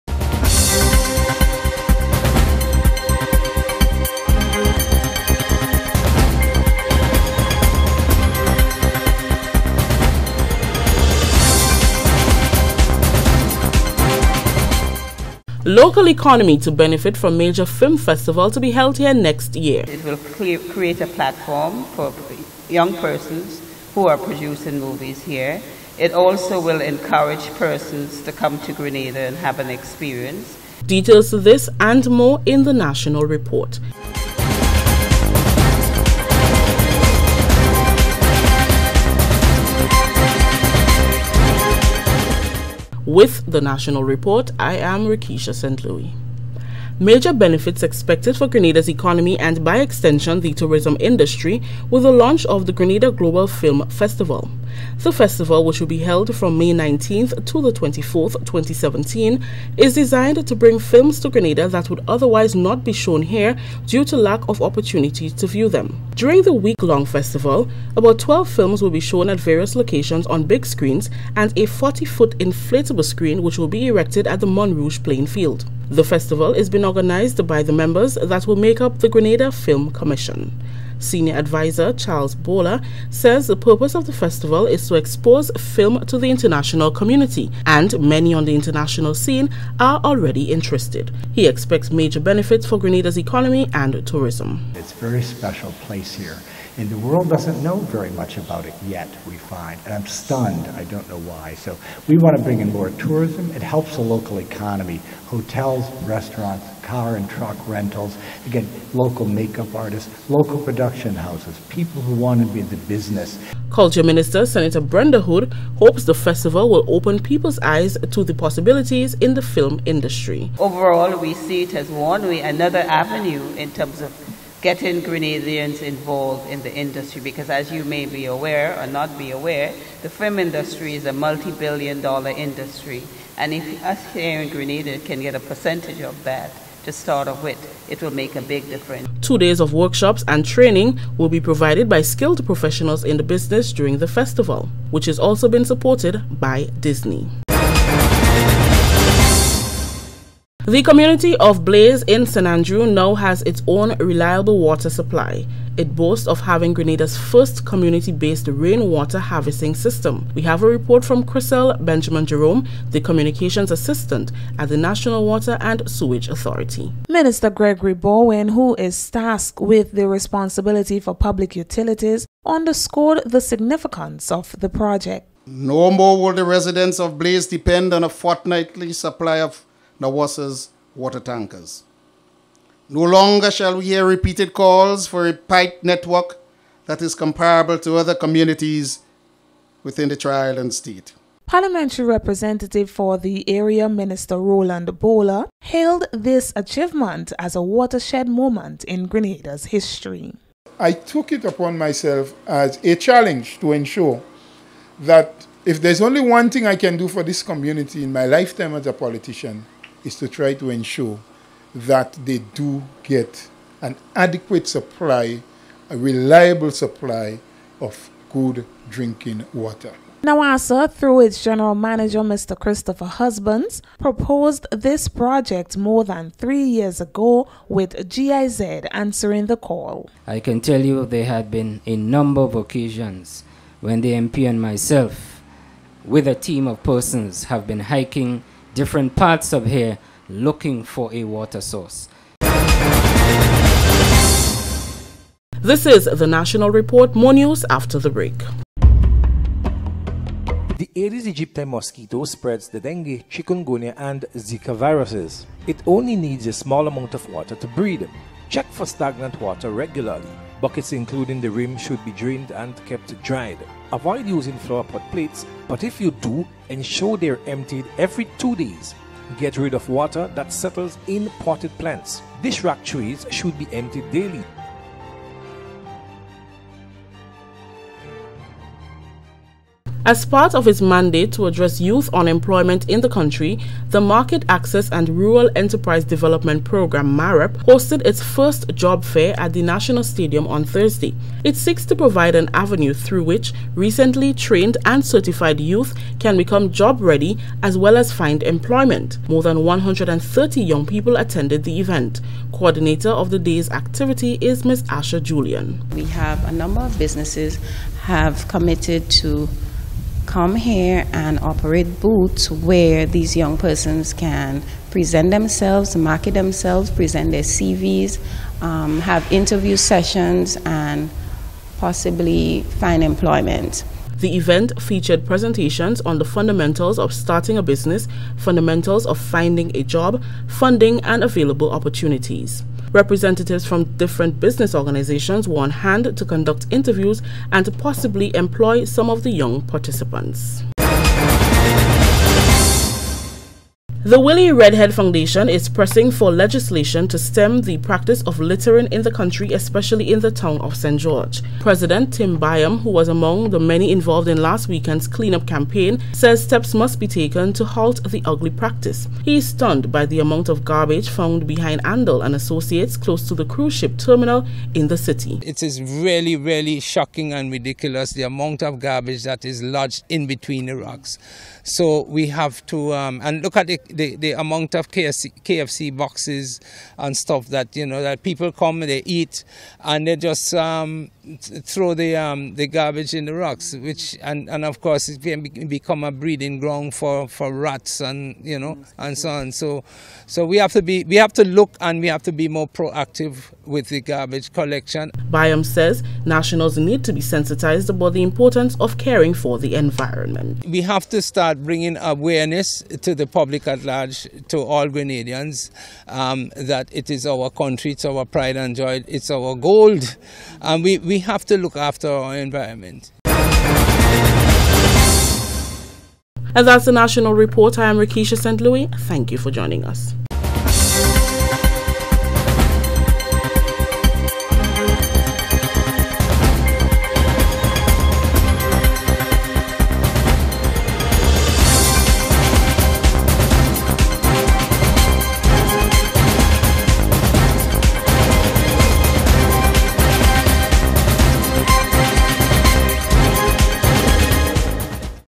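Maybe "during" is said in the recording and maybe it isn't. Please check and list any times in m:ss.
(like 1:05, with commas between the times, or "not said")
1:06, 2:23.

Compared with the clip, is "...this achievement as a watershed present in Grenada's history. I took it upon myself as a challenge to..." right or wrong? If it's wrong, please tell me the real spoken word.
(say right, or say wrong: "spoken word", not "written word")
wrong: "moment", not "present".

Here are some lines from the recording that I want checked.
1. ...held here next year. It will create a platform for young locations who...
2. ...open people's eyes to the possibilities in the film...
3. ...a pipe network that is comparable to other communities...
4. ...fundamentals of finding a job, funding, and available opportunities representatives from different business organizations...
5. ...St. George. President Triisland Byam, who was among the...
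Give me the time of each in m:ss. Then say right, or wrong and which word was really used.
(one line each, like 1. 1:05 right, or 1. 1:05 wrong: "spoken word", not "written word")
1. 0:18 wrong: "persons", not "locations"
2. 1:56 right
3. 3:05 right
4. 5:28 right
5. 5:50 wrong: "Tim", not "Triisland".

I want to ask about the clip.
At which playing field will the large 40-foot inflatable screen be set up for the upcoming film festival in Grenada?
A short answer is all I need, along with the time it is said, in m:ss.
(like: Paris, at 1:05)
Montrouge, at 1:14.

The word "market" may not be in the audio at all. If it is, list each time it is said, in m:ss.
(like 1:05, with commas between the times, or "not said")
4:44, 5:15.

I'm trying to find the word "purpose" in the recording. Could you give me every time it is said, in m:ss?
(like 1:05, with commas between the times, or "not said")
1:23.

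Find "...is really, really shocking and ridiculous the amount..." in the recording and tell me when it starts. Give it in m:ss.
6:05.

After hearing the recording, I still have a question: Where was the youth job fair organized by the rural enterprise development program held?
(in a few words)
National Stadium.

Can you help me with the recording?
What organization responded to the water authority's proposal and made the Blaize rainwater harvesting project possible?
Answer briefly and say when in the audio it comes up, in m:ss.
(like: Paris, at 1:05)
GIZ, at 3:48.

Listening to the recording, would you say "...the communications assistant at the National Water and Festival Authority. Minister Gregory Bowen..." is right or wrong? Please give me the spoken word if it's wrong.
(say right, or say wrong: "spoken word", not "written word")
wrong: "Sewage", not "Festival".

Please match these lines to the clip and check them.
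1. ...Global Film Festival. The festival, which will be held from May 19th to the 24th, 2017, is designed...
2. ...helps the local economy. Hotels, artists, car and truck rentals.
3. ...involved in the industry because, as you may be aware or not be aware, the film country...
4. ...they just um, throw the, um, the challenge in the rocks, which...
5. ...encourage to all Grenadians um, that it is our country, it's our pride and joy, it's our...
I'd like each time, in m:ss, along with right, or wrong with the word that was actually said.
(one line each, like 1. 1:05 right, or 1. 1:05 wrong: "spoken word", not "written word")
1. 0:53 right
2. 1:43 wrong: "restaurants", not "artists"
3. 2:05 wrong: "industry", not "country"
4. 6:20 wrong: "garbage", not "challenge"
5. 6:43 wrong: "large", not "encourage".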